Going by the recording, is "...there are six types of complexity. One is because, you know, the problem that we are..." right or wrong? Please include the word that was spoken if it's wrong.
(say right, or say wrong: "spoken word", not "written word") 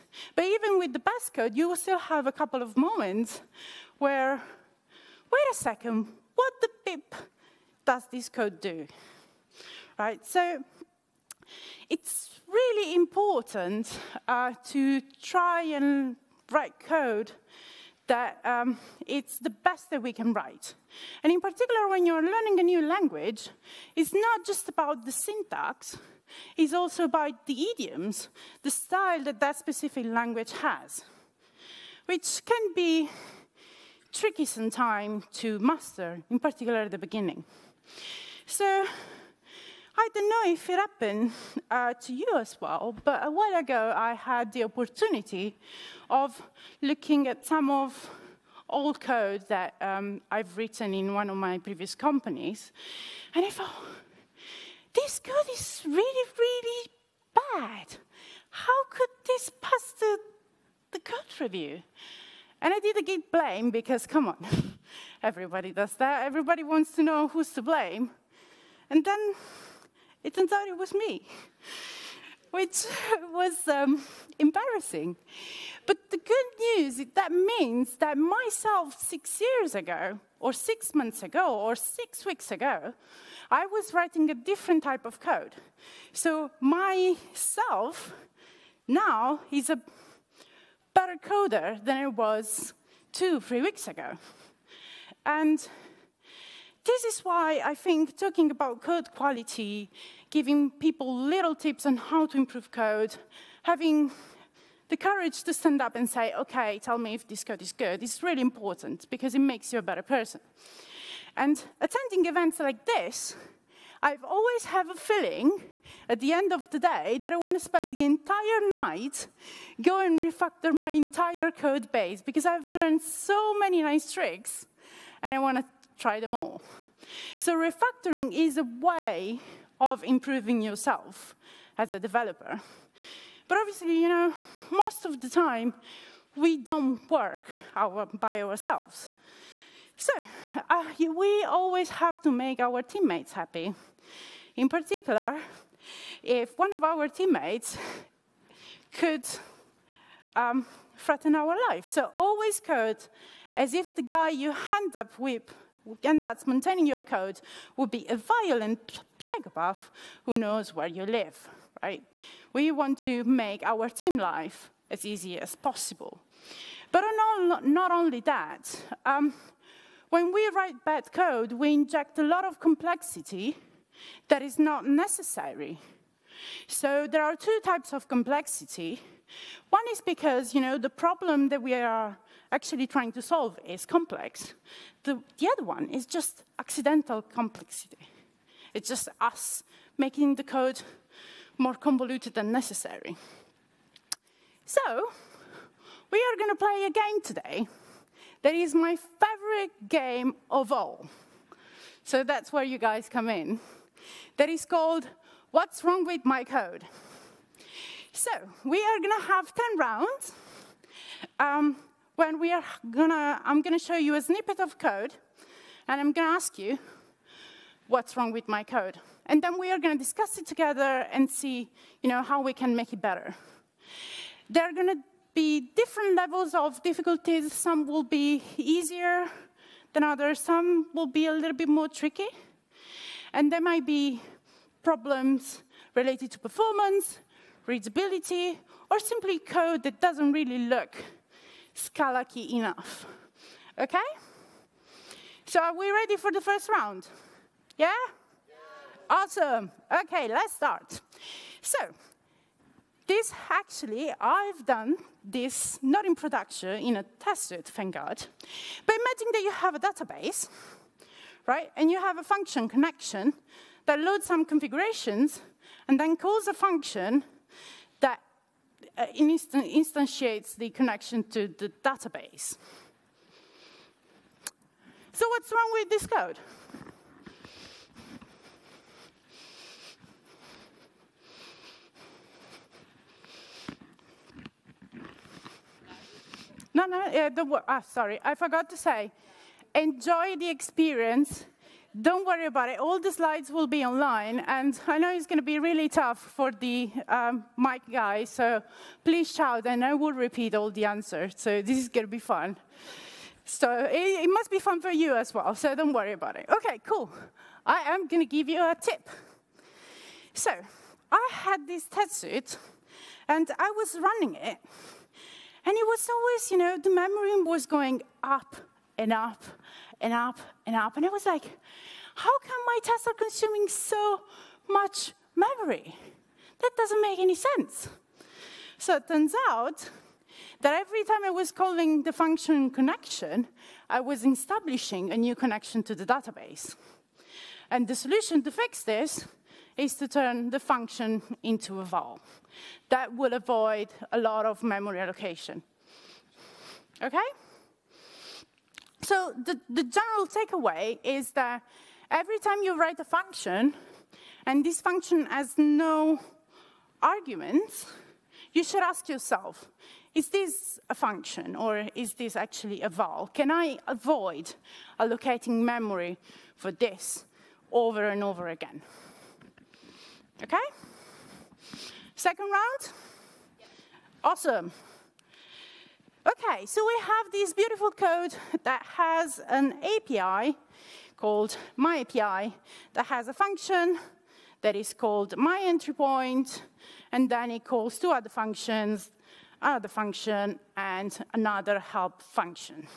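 wrong: "two", not "six".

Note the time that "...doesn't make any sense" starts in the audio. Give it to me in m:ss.
5:26.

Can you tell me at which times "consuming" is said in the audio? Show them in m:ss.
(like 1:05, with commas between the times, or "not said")
5:23.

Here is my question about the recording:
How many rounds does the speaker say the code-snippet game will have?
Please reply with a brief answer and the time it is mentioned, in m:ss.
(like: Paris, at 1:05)
10, at 3:29.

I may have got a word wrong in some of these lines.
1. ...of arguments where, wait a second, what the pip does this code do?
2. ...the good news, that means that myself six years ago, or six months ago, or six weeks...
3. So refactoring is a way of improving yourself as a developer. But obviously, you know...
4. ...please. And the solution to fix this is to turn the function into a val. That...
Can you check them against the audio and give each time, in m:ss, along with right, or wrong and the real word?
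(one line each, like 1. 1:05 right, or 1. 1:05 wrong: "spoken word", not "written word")
1. 0:02 wrong: "moments", not "arguments"
2. 1:16 right
3. 2:07 right
4. 5:36 wrong: "database", not "please".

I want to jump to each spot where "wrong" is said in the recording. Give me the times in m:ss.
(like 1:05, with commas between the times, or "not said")
3:25, 3:38, 4:35.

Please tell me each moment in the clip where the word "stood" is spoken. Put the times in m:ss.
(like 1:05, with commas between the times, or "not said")
not said.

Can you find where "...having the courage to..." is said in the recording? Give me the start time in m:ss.
1:43.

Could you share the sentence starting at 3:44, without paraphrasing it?
There are gonna be different levels of difficulties.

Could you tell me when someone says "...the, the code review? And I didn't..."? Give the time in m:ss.
0:59.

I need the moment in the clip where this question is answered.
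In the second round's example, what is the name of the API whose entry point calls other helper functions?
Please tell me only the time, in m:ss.
6:21.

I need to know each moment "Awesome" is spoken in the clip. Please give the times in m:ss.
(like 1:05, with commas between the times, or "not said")
4:09, 6:14.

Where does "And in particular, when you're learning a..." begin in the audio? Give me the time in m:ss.
0:21.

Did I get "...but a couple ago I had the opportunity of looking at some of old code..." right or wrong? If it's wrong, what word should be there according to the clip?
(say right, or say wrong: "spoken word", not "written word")
wrong: "while", not "couple".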